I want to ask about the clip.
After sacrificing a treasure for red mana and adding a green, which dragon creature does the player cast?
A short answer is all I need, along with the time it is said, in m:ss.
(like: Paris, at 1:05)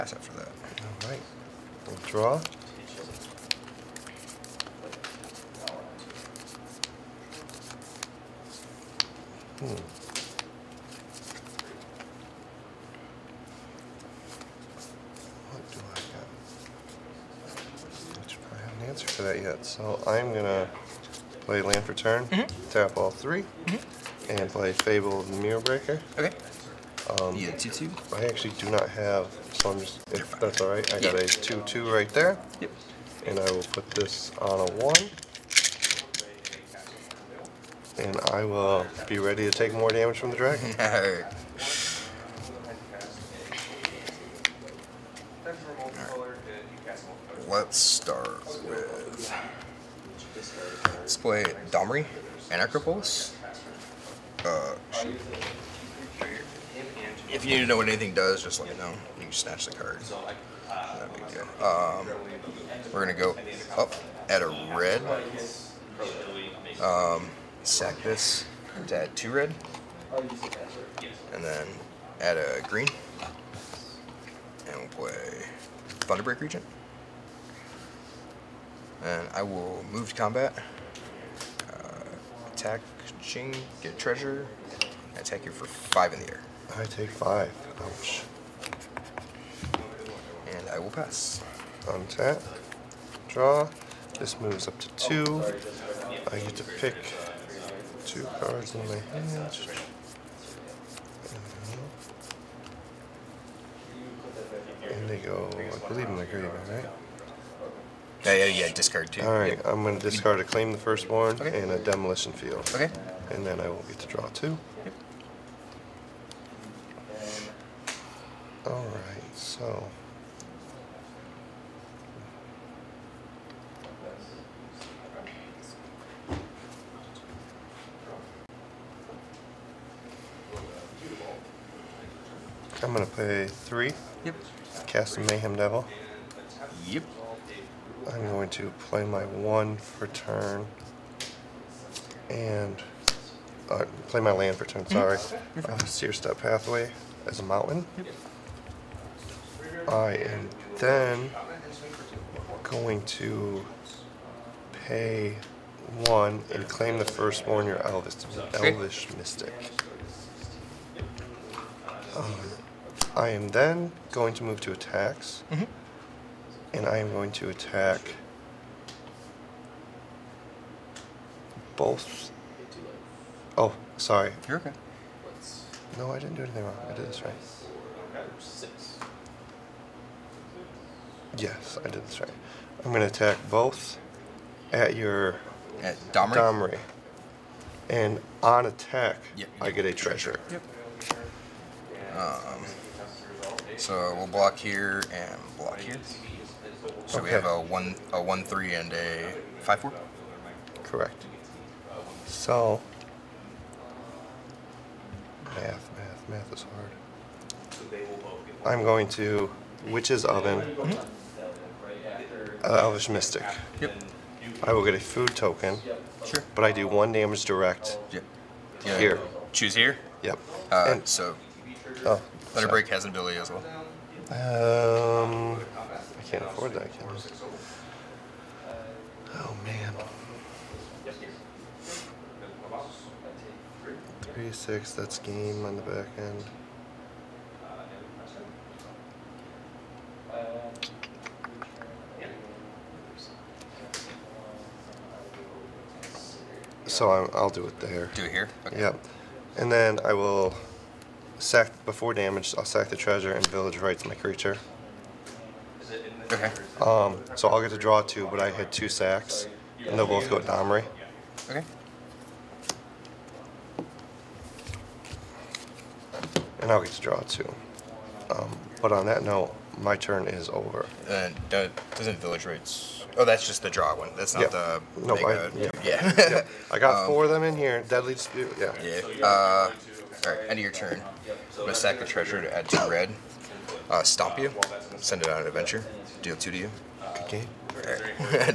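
Thunderbreak Regent, at 1:16.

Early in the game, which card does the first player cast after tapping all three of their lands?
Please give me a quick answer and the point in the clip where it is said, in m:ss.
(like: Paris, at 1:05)
Fable of the Mirror Breaker, at 0:24.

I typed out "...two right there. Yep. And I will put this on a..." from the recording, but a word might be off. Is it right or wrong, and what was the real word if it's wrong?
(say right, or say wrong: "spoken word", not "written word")
right.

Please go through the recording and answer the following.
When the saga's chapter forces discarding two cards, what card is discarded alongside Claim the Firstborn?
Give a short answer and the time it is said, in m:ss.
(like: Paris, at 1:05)
Demolition Field, at 1:51.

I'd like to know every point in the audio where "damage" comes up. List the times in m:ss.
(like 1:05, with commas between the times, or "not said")
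0:39, 3:37, 4:12.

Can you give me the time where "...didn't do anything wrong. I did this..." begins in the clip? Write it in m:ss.
2:56.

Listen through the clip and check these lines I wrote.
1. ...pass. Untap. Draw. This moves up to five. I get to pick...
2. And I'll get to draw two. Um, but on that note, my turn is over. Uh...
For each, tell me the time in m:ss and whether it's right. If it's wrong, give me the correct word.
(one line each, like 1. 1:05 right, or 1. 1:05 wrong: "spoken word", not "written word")
1. 1:30 wrong: "two", not "five"
2. 4:26 right.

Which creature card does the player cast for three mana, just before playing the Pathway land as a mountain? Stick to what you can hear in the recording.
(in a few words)
Mayhem Devil.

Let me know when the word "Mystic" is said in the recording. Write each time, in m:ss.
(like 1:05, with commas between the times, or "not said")
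2:39, 3:33.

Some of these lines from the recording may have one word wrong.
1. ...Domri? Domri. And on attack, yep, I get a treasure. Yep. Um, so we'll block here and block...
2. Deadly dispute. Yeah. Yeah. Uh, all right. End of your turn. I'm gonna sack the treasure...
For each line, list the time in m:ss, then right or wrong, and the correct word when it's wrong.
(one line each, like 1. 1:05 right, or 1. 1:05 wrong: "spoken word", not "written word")
1. 3:06 right
2. 4:37 right.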